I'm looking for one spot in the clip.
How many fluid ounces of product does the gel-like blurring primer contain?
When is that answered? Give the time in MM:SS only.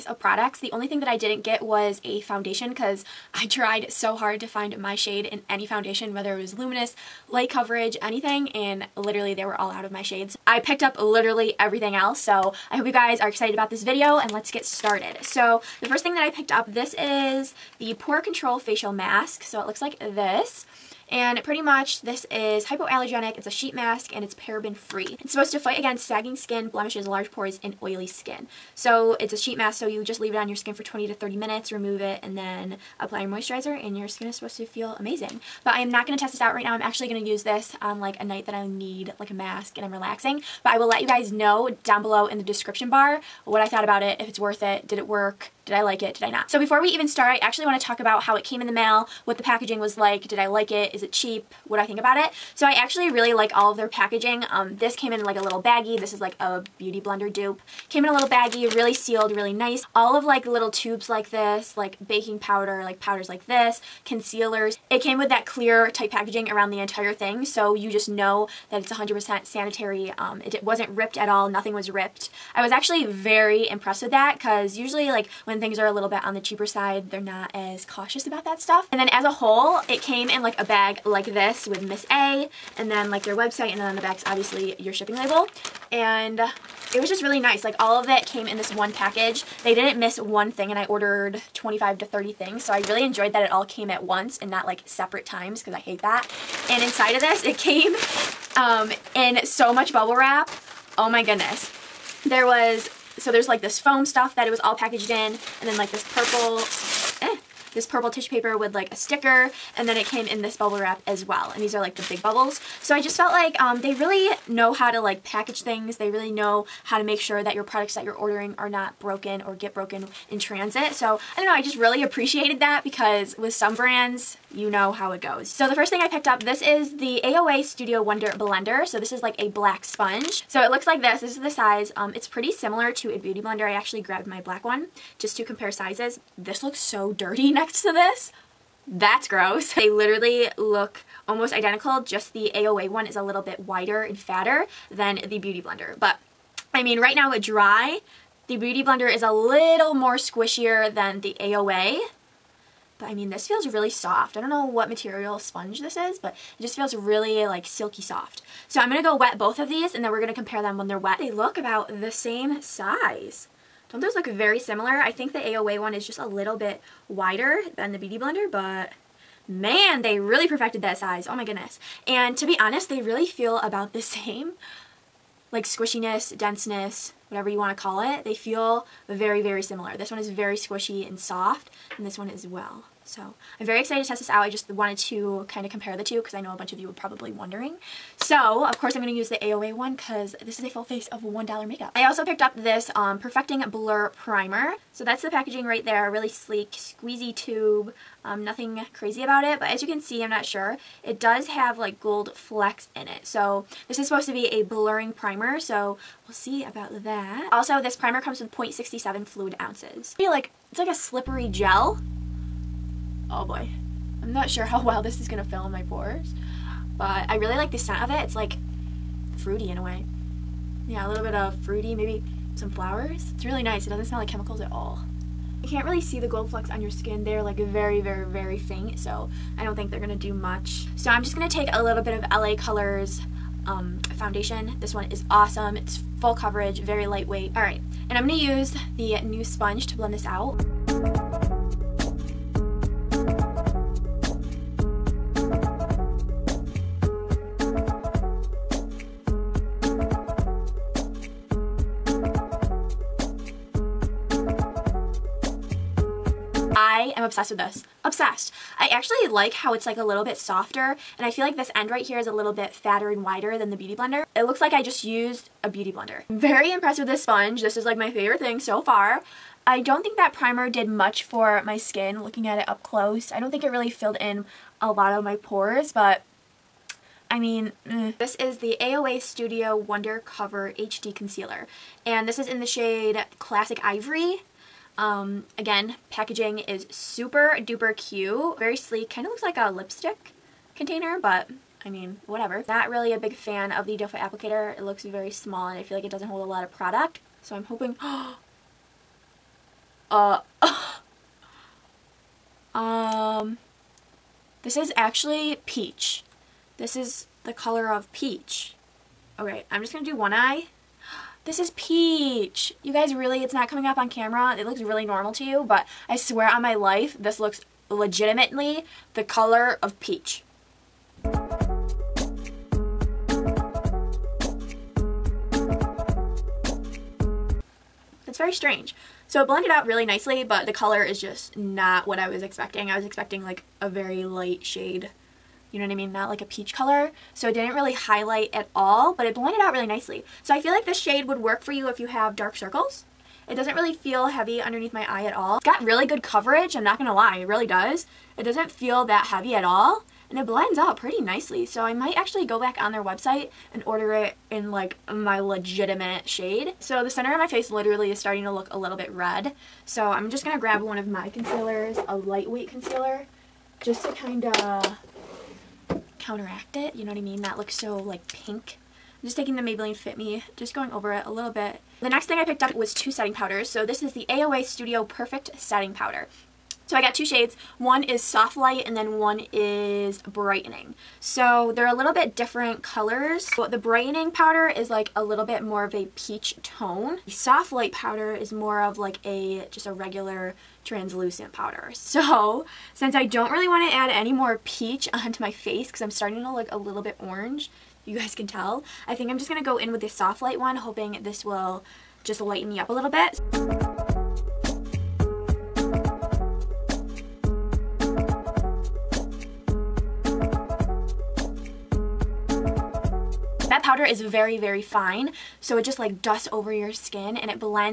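03:28.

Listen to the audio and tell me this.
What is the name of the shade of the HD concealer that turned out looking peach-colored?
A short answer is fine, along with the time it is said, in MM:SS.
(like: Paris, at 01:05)
Classic Ivory, at 04:43.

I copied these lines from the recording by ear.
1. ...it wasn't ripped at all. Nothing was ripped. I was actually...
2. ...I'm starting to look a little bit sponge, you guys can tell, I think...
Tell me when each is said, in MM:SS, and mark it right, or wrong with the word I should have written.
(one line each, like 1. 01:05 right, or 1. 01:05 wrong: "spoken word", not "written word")
1. 01:10 right
2. 06:36 wrong: "orange", not "sponge".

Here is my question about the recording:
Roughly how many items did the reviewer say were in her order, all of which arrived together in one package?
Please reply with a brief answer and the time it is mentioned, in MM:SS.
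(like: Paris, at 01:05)
25 to 30, at 01:31.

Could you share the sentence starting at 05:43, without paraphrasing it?
It doesn't really feel heavy underneath my eye at all.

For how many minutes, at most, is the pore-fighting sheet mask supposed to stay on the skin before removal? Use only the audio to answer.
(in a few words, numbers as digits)
30.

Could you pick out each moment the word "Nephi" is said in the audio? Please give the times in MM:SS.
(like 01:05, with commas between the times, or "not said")
not said.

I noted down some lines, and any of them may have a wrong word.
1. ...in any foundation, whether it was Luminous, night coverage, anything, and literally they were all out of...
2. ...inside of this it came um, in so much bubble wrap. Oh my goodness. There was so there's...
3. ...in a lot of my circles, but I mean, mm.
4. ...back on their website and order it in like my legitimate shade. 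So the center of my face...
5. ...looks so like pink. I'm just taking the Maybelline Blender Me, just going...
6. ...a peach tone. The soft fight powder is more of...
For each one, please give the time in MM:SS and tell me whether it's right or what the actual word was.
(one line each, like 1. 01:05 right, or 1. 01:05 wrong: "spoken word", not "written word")
1. 00:05 wrong: "light", not "night"
2. 01:36 right
3. 04:34 wrong: "pores", not "circles"
4. 05:52 right
5. 06:07 wrong: "Fit", not "Blender"
6. 06:25 wrong: "light", not "fight".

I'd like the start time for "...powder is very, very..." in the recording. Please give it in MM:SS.
06:53.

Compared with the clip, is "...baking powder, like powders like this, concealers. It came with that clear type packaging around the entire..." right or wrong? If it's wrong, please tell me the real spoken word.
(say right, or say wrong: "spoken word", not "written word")
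right.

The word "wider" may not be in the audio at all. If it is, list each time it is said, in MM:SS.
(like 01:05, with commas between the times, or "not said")
02:23, 02:47, 04:23.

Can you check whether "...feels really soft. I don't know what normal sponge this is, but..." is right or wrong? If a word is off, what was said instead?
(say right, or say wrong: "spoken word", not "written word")
wrong: "material", not "normal".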